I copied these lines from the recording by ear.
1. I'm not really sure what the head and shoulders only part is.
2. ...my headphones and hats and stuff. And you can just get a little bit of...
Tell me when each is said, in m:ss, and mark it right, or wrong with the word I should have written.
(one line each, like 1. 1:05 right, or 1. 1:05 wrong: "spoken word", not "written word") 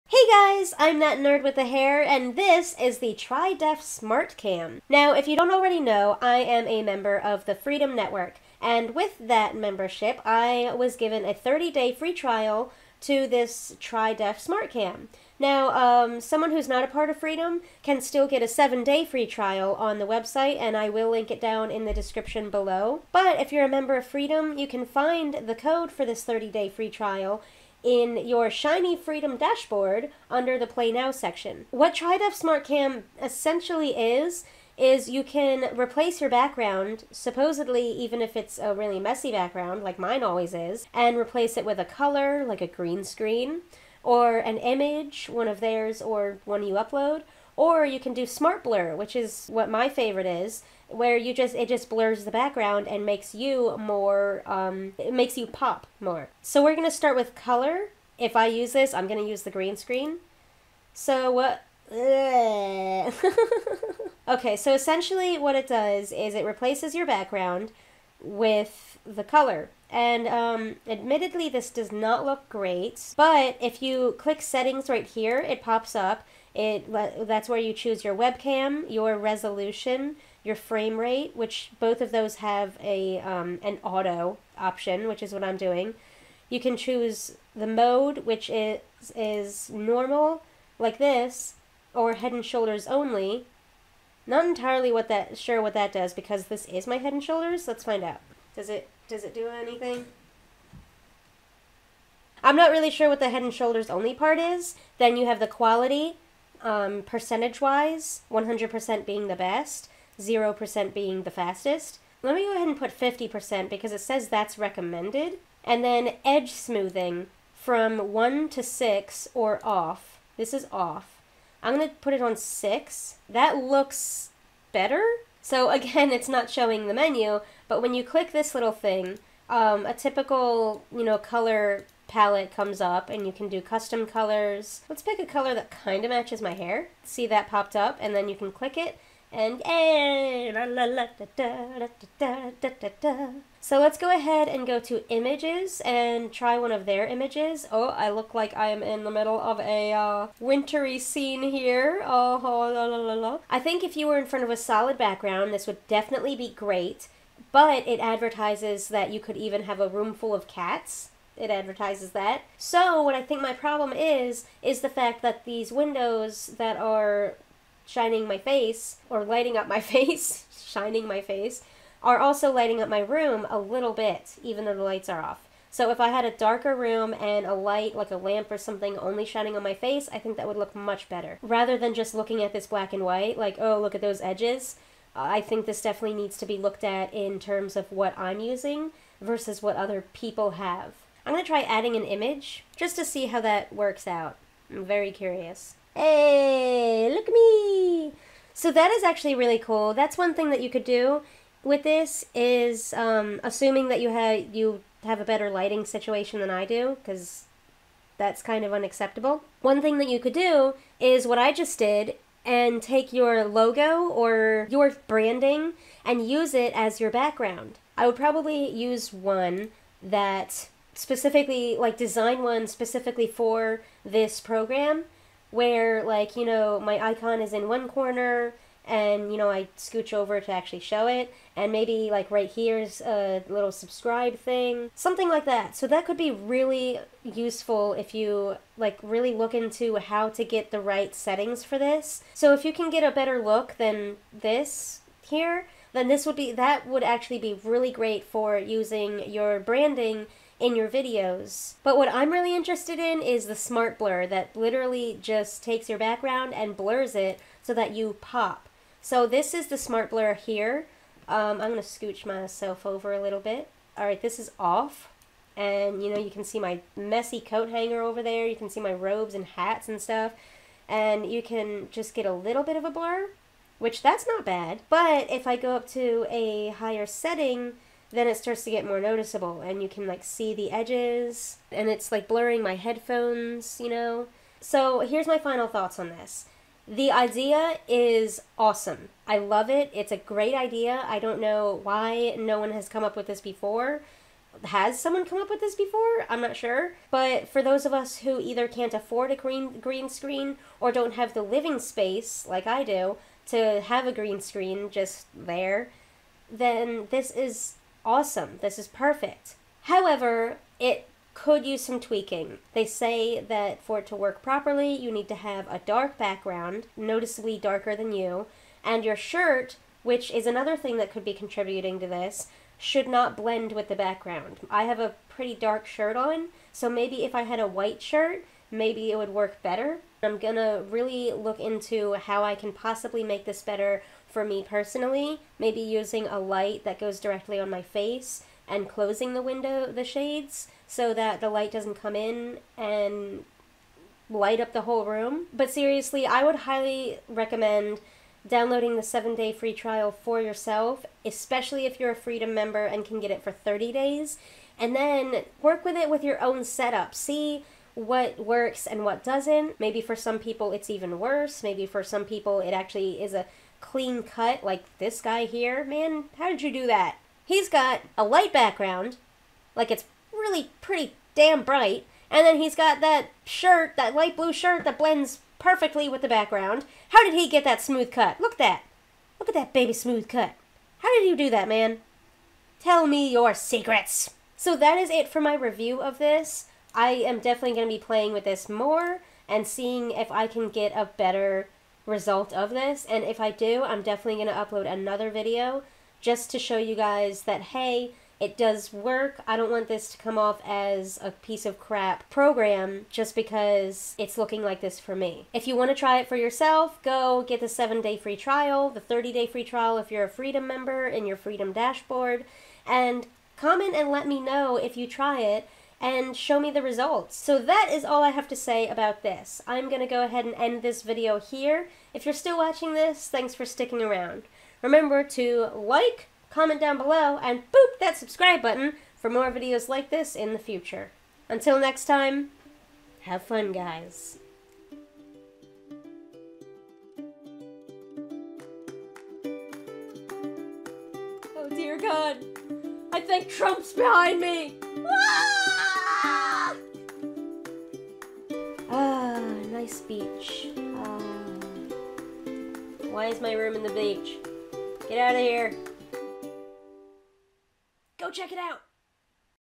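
1. 1:42 right
2. 4:28 wrong: "robes", not "headphones".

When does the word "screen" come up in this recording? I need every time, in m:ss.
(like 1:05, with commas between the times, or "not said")
0:43, 0:59, 5:00, 5:04.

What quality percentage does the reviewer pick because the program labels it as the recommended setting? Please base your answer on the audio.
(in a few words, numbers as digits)
50%.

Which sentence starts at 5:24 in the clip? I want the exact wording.
I have a pretty dark shirt on, so maybe if I had a white shirt, maybe it would work better.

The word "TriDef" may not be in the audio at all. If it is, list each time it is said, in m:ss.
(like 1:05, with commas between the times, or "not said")
0:03, 0:13, 0:31.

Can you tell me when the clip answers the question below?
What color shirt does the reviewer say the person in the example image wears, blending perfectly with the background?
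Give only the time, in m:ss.
6:14.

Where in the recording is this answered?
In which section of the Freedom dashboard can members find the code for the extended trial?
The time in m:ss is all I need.
0:30.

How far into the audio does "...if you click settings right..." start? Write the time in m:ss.
1:13.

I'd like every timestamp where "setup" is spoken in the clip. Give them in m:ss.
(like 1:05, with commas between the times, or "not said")
5:56.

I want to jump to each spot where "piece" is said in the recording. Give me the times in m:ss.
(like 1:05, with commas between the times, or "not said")
6:41.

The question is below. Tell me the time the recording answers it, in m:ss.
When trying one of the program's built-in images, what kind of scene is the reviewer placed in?
2:30.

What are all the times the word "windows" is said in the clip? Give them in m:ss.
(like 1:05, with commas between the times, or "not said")
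2:45, 5:39.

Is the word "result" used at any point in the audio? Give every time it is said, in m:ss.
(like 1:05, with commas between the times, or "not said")
6:32, 6:56.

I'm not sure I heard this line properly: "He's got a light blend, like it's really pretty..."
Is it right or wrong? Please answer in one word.
wrong.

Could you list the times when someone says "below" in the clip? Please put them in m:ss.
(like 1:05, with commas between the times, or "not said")
0:22, 7:06.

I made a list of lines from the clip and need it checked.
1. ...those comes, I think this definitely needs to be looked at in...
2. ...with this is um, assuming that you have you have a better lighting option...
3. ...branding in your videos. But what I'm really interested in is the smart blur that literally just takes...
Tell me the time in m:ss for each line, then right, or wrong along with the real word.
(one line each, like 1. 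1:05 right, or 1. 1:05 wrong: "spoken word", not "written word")
1. 3:04 wrong: "edges", not "comes"
2. 3:21 wrong: "situation", not "option"
3. 4:09 right.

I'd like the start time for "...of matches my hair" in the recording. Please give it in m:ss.
2:16.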